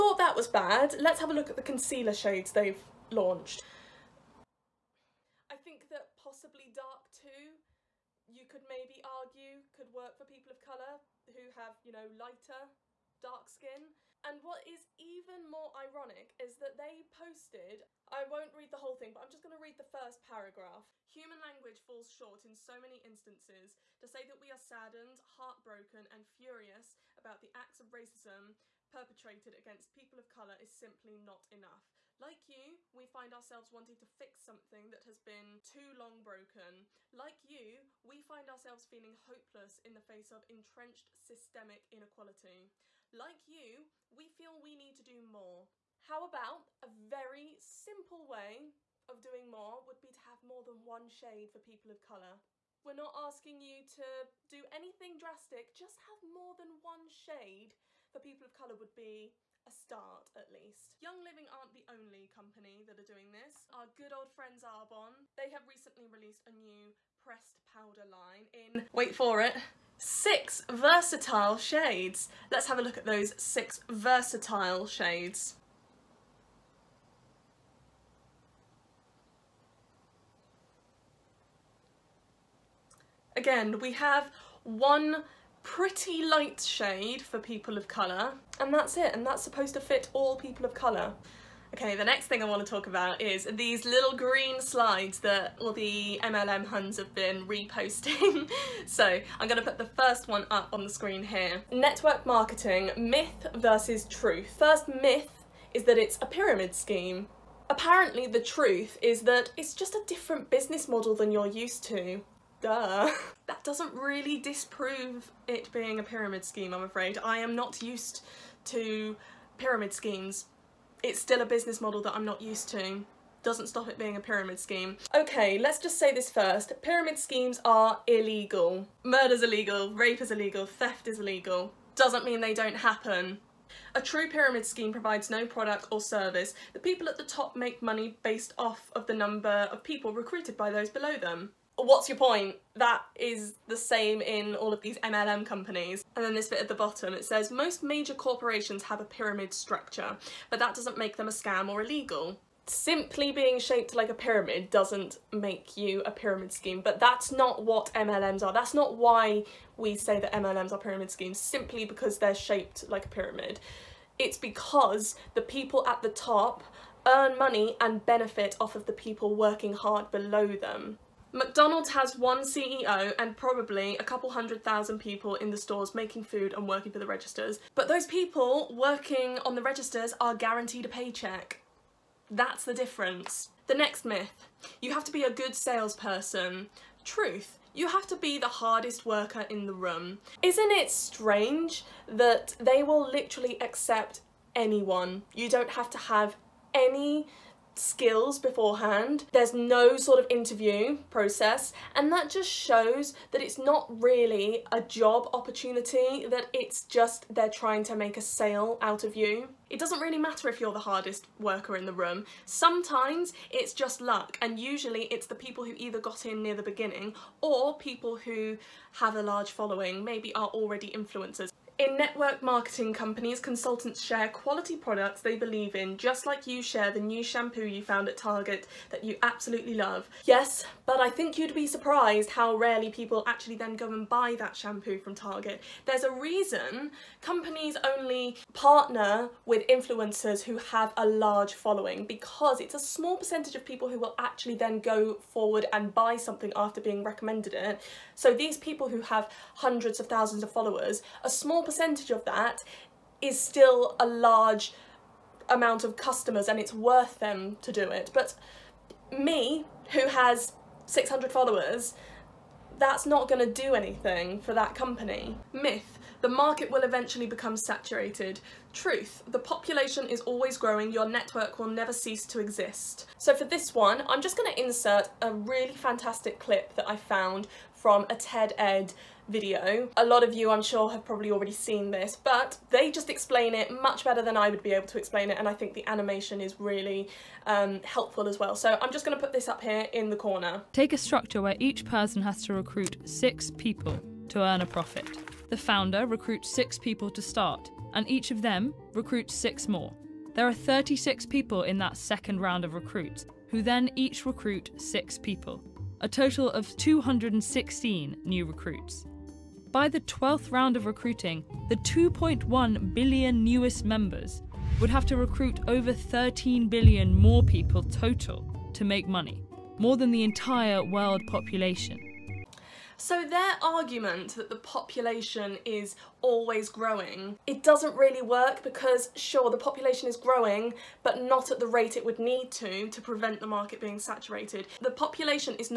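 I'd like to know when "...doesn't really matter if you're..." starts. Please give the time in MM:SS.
03:29.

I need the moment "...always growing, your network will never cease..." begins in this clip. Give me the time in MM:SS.
04:30.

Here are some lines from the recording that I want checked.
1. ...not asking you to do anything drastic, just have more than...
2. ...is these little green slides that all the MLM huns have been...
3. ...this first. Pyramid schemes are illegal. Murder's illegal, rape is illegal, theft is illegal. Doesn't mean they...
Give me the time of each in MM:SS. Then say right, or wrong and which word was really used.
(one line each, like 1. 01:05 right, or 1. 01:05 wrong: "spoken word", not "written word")
1. 00:52 right
2. 01:33 right
3. 02:06 right.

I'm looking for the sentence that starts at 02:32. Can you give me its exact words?
Simply being shaped like a pyramid doesn't make you a pyramid scheme, but that's not what MLMs are.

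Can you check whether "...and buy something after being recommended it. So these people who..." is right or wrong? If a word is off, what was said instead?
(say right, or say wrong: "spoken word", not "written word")
right.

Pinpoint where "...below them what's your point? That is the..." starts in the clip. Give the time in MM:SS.
02:20.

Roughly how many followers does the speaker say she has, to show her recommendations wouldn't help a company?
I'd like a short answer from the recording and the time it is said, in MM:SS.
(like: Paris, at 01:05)
600, at 04:20.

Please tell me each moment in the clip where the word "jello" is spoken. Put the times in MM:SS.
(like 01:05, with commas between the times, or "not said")
not said.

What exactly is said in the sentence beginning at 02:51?
McDonald's has one CEO and probably a couple hundred thousand people in the stores making food and working for the registers.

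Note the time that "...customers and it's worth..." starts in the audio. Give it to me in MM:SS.
04:15.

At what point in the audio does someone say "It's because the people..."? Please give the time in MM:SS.
02:44.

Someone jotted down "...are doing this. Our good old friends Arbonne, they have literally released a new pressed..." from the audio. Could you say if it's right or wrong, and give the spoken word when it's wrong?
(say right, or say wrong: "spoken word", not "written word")
wrong: "recently", not "literally".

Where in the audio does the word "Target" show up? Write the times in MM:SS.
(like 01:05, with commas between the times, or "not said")
03:48, 03:55.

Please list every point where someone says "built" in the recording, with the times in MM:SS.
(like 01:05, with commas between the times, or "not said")
not said.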